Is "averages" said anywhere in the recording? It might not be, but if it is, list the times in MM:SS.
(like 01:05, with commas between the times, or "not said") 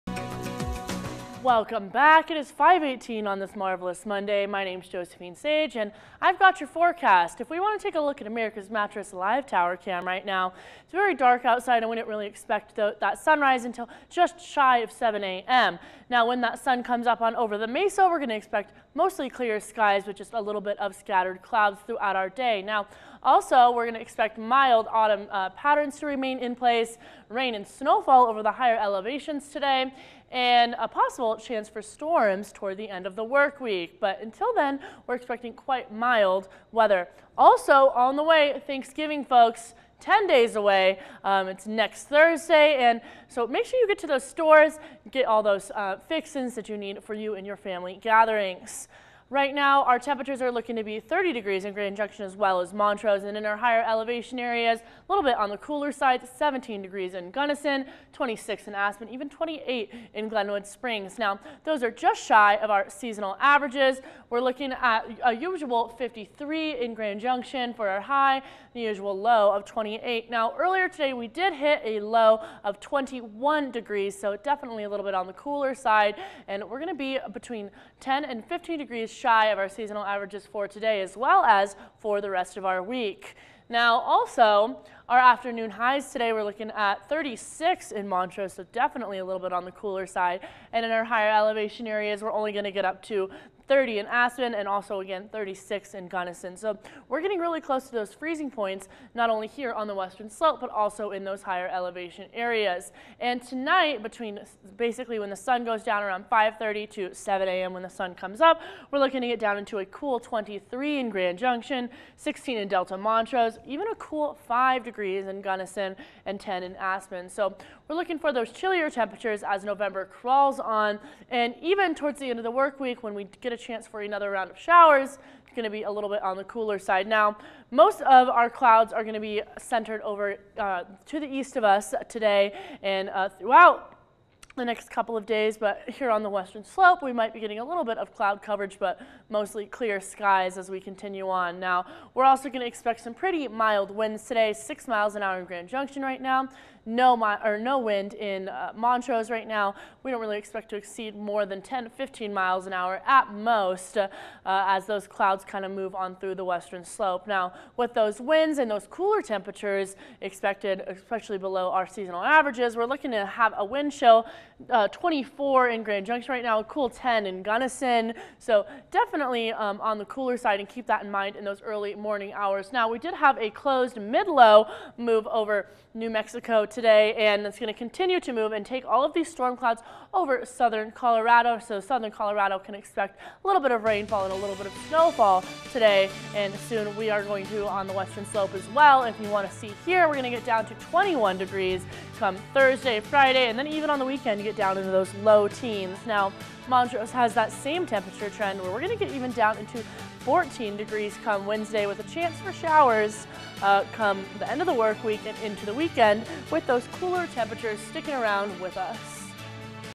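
01:03, 01:20, 02:42.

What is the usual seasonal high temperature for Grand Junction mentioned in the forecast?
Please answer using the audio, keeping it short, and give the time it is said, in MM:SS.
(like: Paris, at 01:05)
53, at 01:05.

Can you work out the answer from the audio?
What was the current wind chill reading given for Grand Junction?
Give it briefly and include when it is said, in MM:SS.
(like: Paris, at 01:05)
24, at 02:44.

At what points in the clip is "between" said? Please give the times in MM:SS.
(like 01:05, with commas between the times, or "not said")
01:17, 01:44.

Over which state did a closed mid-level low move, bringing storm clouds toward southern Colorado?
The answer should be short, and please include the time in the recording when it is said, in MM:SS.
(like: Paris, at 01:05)
New Mexico, at 02:55.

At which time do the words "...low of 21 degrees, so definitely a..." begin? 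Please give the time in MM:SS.
01:12.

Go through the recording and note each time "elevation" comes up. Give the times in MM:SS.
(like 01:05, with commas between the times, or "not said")
00:28, 00:53, 01:31, 01:41.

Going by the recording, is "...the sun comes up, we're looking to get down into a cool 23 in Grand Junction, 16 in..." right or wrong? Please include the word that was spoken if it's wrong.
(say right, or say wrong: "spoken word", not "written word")
right.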